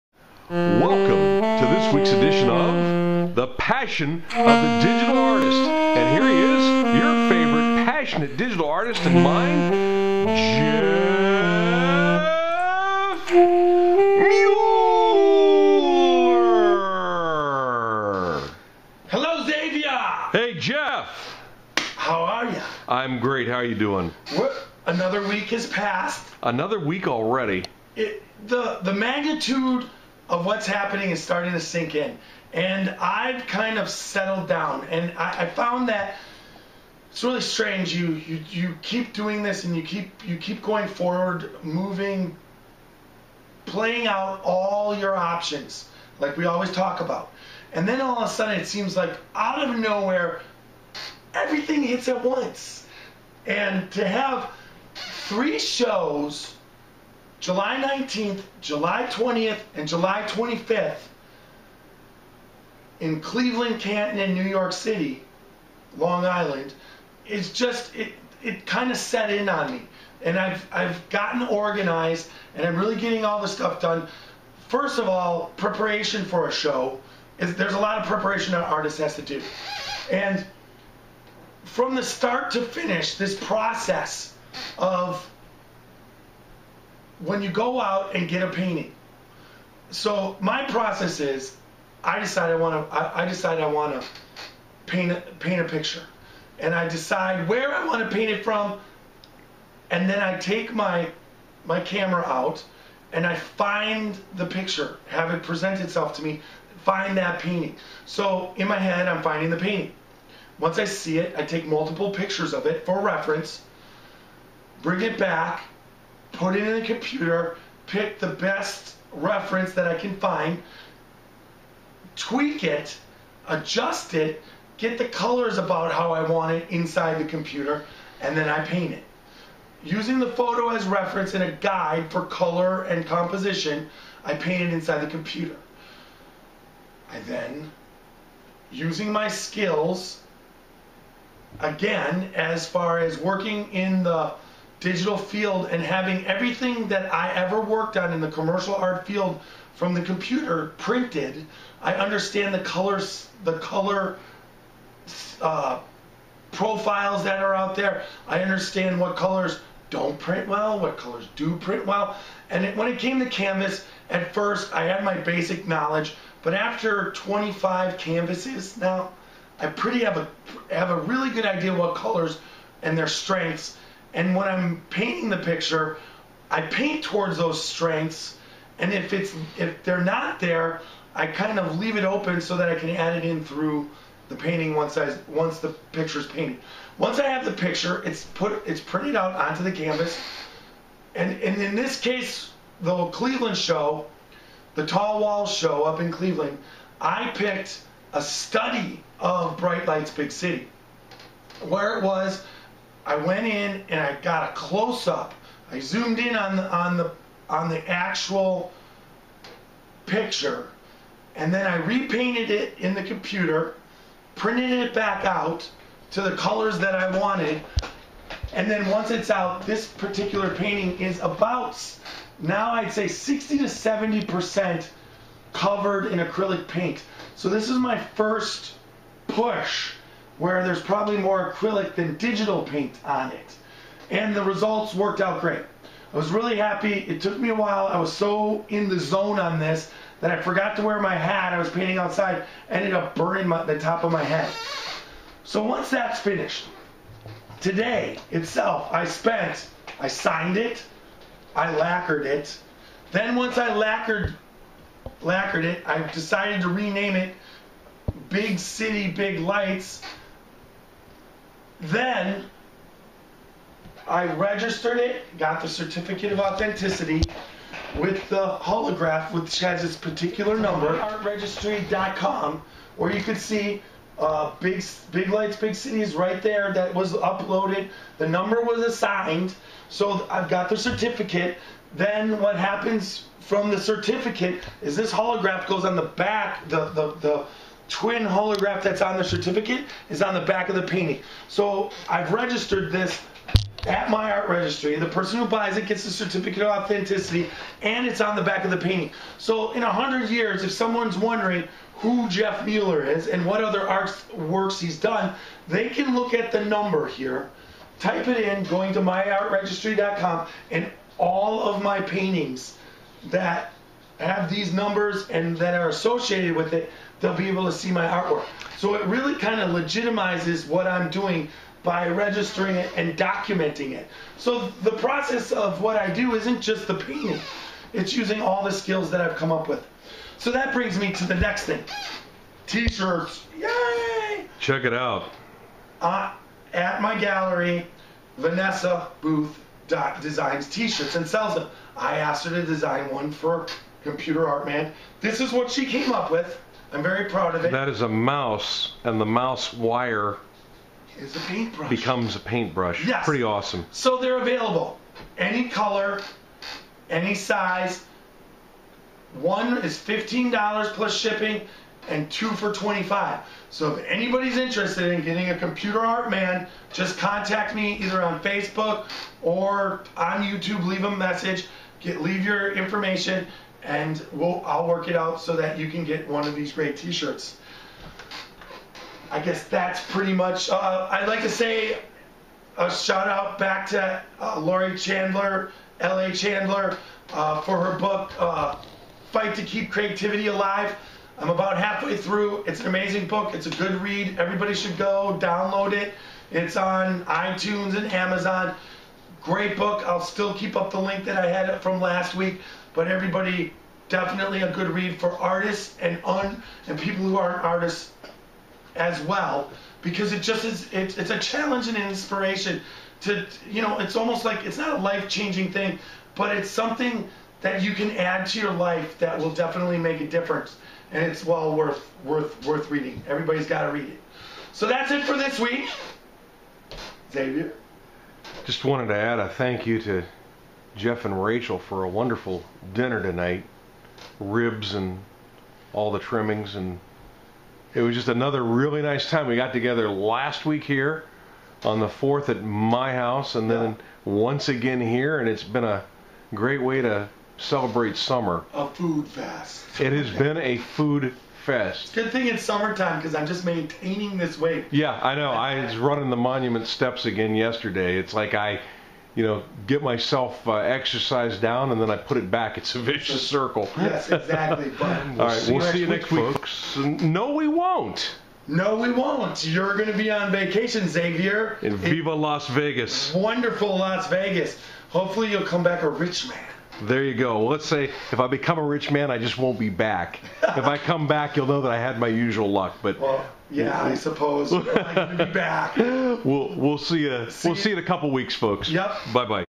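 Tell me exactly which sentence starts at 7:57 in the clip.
Let's say if I become a rich man, I just won't be back.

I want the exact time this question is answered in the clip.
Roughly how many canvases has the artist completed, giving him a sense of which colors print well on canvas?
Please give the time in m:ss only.
2:47.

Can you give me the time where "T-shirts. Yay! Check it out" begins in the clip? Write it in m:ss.
5:32.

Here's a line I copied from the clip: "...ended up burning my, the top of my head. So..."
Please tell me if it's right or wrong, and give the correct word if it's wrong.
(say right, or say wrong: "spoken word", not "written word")
right.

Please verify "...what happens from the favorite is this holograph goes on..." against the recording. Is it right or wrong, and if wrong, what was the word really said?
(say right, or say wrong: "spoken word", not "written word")
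wrong: "certificate", not "favorite".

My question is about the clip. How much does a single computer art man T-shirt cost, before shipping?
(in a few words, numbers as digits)
$15.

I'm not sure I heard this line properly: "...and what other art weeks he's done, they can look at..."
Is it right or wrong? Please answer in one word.
wrong.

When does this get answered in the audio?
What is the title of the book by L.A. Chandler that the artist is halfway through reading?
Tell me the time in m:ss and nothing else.
6:29.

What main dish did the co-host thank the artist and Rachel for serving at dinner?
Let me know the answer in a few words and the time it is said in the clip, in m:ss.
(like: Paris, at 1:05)
Ribs, at 7:14.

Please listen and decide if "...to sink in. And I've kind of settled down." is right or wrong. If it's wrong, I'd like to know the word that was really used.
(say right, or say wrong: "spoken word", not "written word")
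right.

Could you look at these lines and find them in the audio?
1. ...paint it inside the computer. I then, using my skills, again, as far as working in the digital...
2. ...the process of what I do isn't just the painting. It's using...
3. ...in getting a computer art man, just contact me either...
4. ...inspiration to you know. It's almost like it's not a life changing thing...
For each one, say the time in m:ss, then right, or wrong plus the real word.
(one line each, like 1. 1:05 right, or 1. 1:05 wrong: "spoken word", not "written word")
1. 2:14 right
2. 5:24 right
3. 6:05 right
4. 6:52 right.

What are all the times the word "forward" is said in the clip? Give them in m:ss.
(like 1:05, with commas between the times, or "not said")
0:40.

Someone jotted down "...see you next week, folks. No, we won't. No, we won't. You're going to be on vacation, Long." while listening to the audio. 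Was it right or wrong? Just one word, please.
wrong.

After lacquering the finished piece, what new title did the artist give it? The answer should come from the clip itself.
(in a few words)
Big City Big Lights.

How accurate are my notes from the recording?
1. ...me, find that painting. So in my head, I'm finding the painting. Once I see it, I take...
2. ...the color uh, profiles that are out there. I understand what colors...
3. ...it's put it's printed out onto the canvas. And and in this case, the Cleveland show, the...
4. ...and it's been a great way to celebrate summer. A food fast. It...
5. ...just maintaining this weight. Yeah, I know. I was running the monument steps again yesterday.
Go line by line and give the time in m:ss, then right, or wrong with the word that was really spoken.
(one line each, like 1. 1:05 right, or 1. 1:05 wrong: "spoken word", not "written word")
1. 1:46 right
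2. 2:33 right
3. 3:08 right
4. 7:25 right
5. 7:33 right.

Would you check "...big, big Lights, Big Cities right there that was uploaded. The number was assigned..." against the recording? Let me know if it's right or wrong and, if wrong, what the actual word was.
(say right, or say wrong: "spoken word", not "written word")
right.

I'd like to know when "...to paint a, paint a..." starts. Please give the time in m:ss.
1:34.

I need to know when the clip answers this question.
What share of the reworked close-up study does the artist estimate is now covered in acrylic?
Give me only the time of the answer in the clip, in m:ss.
3:43.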